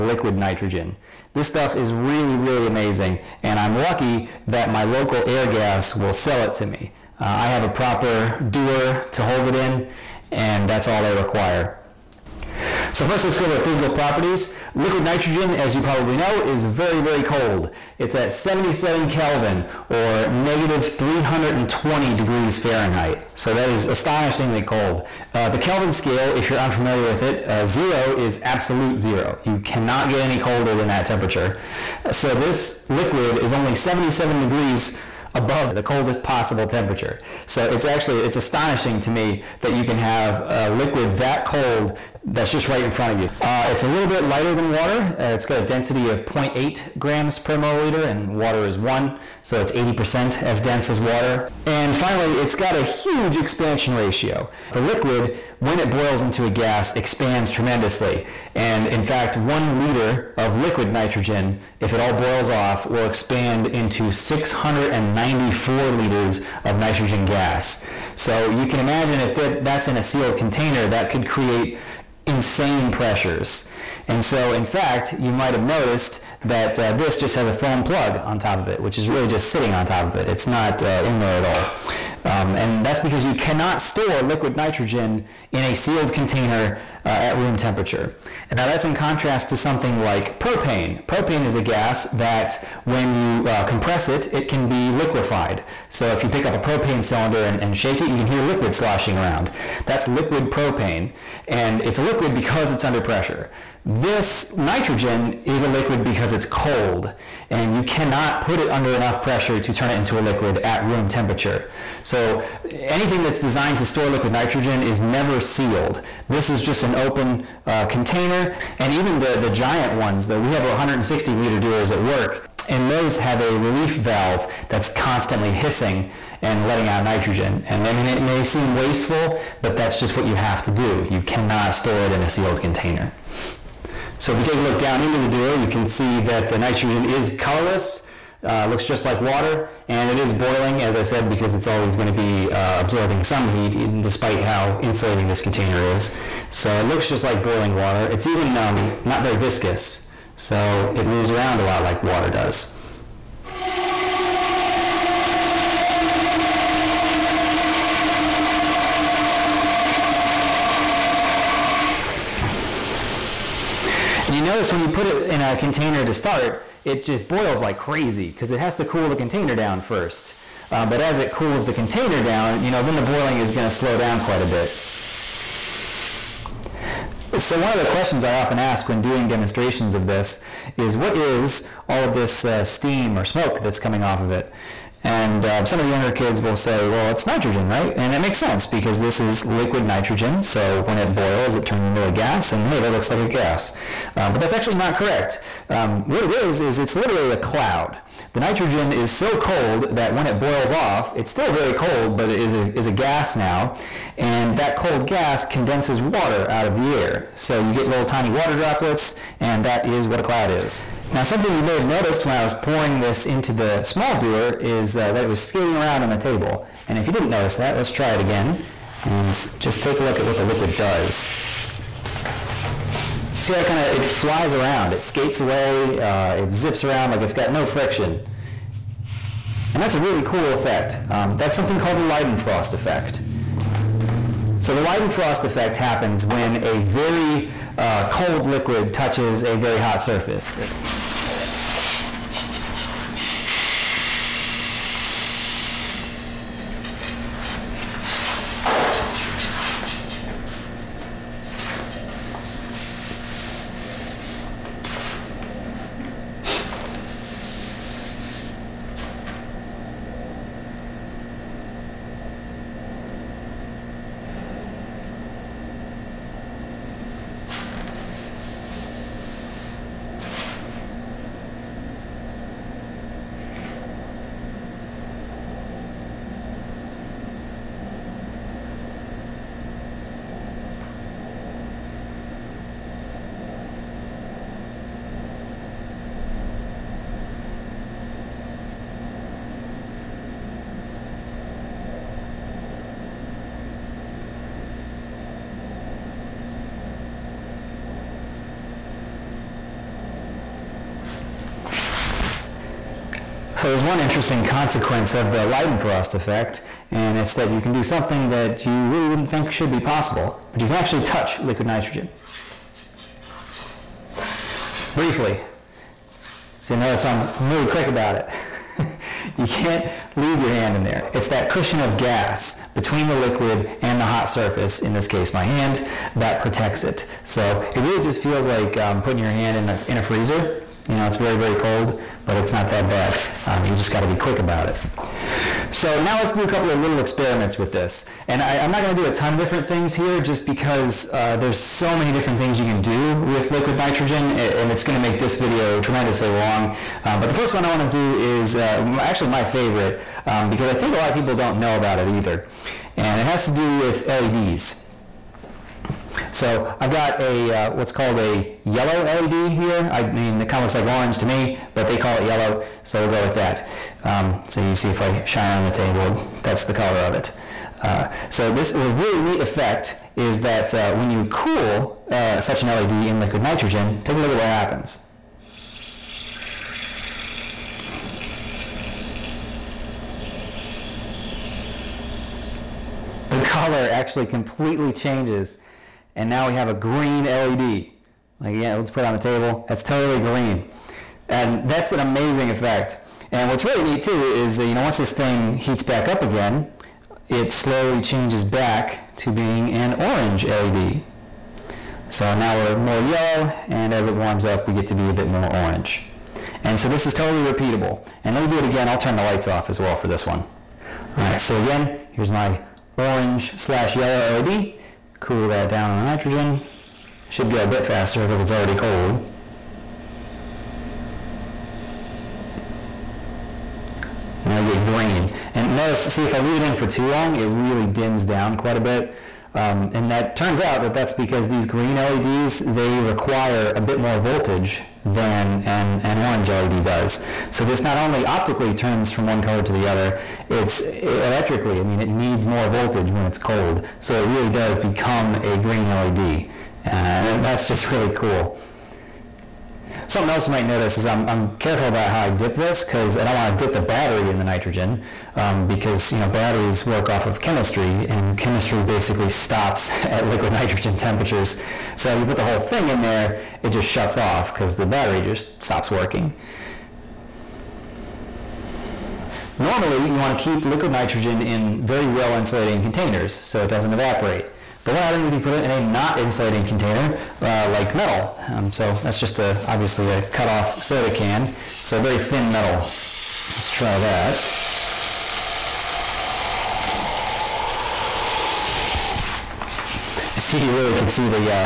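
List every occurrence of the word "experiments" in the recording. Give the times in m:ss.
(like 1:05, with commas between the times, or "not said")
5:36.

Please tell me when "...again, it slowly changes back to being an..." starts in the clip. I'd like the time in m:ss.
6:36.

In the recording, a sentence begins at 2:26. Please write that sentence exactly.
So it looks just like boiling water.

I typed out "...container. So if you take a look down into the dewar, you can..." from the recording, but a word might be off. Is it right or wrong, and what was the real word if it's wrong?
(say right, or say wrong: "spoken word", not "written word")
right.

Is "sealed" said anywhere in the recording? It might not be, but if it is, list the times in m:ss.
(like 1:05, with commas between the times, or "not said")
1:10, 1:25, 1:55, 2:12.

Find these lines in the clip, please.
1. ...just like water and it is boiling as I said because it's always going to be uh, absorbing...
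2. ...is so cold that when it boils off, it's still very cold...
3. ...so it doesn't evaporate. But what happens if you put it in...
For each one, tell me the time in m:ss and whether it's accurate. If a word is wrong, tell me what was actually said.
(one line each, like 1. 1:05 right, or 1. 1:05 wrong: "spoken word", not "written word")
1. 2:18 right
2. 3:18 right
3. 7:53 right.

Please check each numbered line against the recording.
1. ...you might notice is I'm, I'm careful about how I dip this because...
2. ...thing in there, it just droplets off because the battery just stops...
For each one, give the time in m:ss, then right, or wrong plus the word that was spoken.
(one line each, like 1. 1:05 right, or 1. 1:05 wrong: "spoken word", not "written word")
1. 7:30 right
2. 7:42 wrong: "shuts", not "droplets".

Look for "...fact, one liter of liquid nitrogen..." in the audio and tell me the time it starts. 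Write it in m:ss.
0:59.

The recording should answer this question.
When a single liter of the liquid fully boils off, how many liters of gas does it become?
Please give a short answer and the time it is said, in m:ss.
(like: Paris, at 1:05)
694, at 1:04.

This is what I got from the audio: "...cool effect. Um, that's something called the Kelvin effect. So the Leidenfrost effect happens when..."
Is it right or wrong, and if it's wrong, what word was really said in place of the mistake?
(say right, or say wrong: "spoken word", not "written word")
wrong: "Leidenfrost", not "Kelvin".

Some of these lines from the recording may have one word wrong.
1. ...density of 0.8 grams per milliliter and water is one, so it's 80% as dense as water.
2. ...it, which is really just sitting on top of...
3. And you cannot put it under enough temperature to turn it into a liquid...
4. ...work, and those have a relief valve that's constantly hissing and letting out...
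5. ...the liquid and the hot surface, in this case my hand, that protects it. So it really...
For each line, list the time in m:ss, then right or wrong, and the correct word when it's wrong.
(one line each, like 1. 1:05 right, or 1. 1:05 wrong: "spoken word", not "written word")
1. 0:45 right
2. 1:18 right
3. 1:47 wrong: "pressure", not "temperature"
4. 2:01 right
5. 5:23 right.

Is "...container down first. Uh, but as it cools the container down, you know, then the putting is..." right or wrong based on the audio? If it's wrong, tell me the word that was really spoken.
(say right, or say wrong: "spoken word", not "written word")
wrong: "boiling", not "putting".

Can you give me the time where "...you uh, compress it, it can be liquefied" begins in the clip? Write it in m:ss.
1:33.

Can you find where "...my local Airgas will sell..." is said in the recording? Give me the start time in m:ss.
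0:04.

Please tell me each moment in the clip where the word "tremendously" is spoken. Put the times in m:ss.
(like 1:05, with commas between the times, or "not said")
0:57, 5:45.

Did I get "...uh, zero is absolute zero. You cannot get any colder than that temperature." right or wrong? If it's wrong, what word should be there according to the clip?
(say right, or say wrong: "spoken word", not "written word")
right.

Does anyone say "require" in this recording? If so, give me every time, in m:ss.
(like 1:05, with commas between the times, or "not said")
0:11, 7:12.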